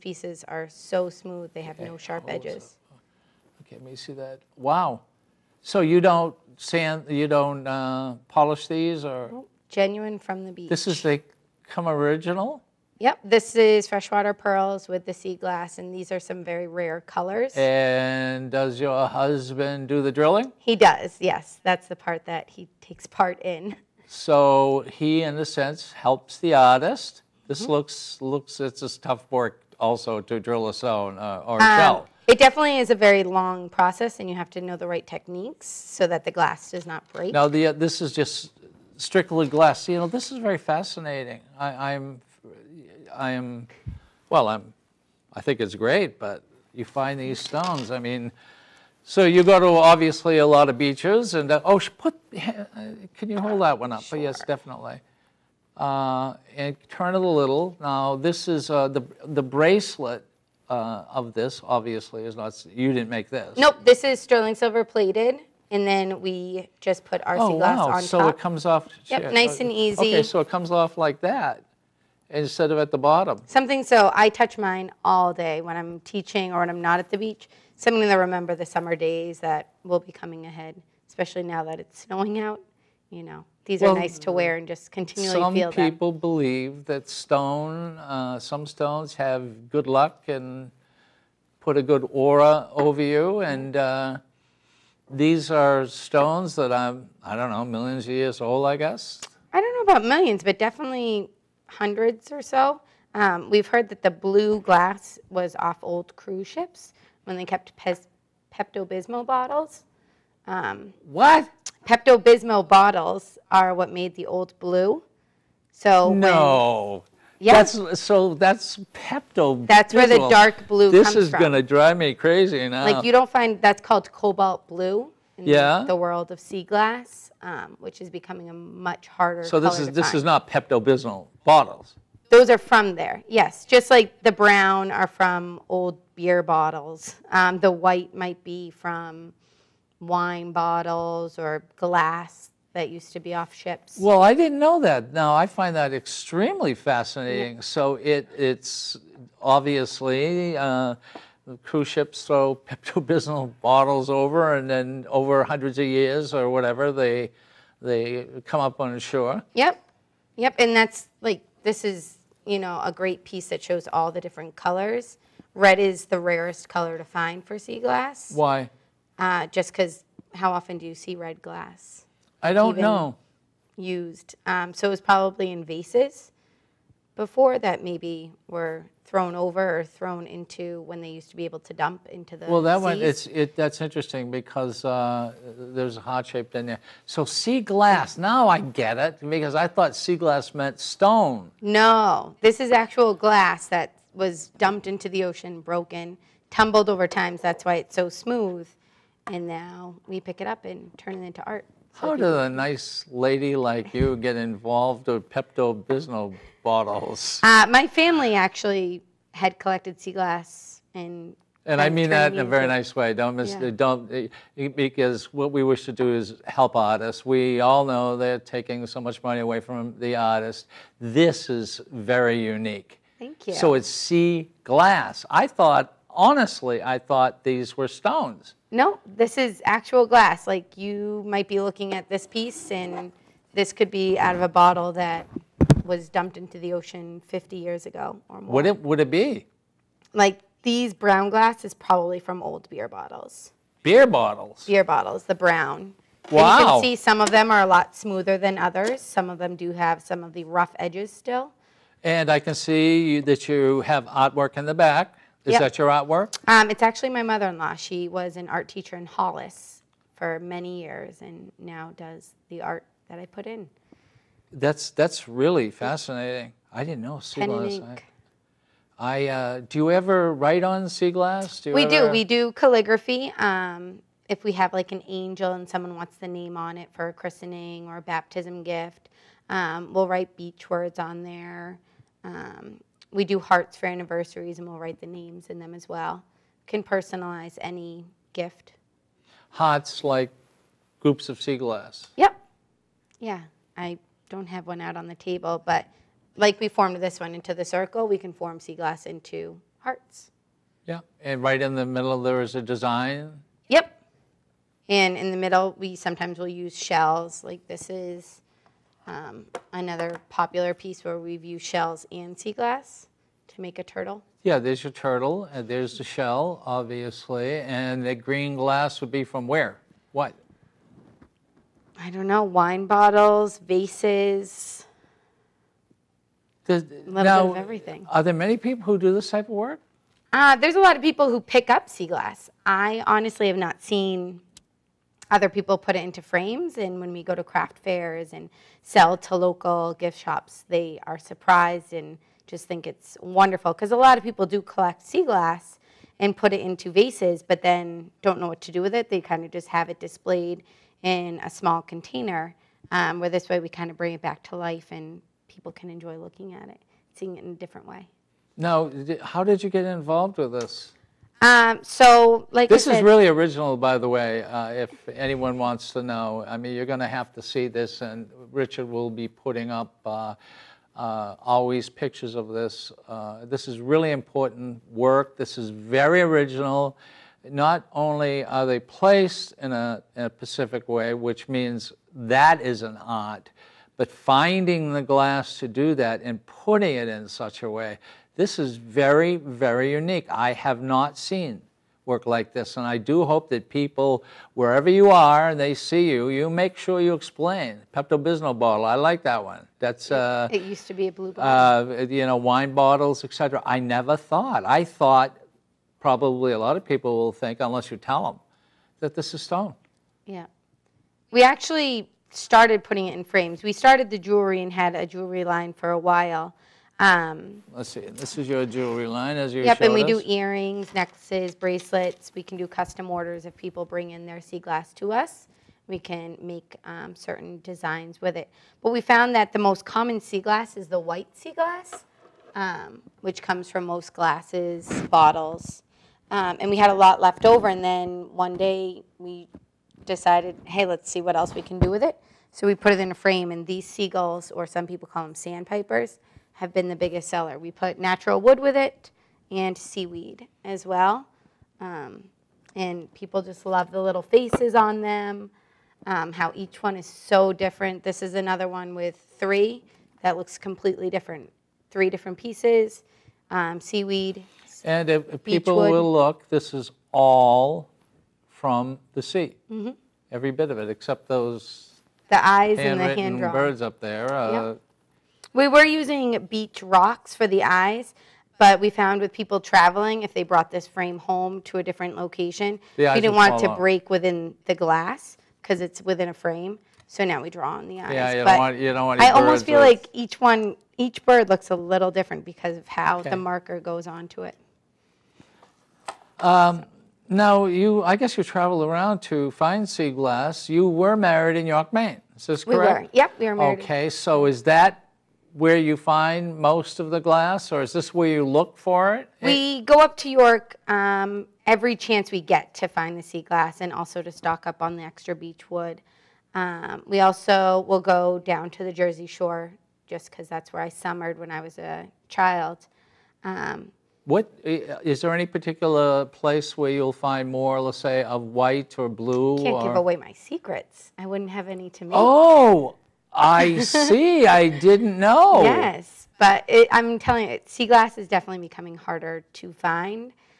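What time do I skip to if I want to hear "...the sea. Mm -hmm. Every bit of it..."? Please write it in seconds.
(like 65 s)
469 s.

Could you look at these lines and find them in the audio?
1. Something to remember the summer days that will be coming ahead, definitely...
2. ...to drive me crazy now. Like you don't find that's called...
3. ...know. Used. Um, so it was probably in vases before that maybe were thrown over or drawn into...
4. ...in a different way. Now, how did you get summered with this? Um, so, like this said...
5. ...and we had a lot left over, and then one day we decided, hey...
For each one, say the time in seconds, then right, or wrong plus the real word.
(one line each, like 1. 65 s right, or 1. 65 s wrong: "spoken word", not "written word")
1. 77 s wrong: "especially", not "definitely"
2. 121 s right
3. 172 s wrong: "thrown", not "drawn"
4. 357 s wrong: "involved", not "summered"
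5. 436 s right.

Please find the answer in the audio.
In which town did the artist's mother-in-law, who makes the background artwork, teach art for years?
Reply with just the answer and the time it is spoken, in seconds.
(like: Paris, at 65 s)
Hollis, at 259 s.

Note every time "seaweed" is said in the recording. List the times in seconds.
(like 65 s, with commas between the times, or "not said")
449 s, 463 s.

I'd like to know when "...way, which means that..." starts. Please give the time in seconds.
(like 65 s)
380 s.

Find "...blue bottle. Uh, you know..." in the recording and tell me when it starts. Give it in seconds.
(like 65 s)
401 s.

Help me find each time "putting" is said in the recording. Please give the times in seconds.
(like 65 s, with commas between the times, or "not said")
369 s, 386 s, 412 s.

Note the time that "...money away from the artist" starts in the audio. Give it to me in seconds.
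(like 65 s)
219 s.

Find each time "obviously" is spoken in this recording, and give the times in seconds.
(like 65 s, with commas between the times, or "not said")
49 s, 61 s, 149 s, 316 s.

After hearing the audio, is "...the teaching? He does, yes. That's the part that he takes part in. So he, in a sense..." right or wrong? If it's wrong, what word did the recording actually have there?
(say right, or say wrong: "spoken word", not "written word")
wrong: "drilling", not "teaching".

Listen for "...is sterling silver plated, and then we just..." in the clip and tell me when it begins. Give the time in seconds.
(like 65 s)
64 s.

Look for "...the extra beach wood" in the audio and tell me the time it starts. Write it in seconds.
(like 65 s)
514 s.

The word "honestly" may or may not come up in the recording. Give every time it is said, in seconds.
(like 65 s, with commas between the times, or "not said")
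226 s, 333 s.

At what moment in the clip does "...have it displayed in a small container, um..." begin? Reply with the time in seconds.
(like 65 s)
349 s.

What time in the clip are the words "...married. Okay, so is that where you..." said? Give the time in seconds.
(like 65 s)
503 s.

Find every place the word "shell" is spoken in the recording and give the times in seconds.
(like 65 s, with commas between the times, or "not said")
31 s, 306 s, 311 s, 316 s.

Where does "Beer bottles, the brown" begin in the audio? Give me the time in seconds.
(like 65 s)
244 s.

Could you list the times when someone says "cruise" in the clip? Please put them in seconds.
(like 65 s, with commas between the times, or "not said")
106 s, 151 s.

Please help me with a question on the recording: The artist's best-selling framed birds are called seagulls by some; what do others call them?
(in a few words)
Sandpipers.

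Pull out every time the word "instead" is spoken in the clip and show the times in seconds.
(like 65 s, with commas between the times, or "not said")
72 s.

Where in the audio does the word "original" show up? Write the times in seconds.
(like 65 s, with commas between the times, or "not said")
11 s, 363 s, 376 s.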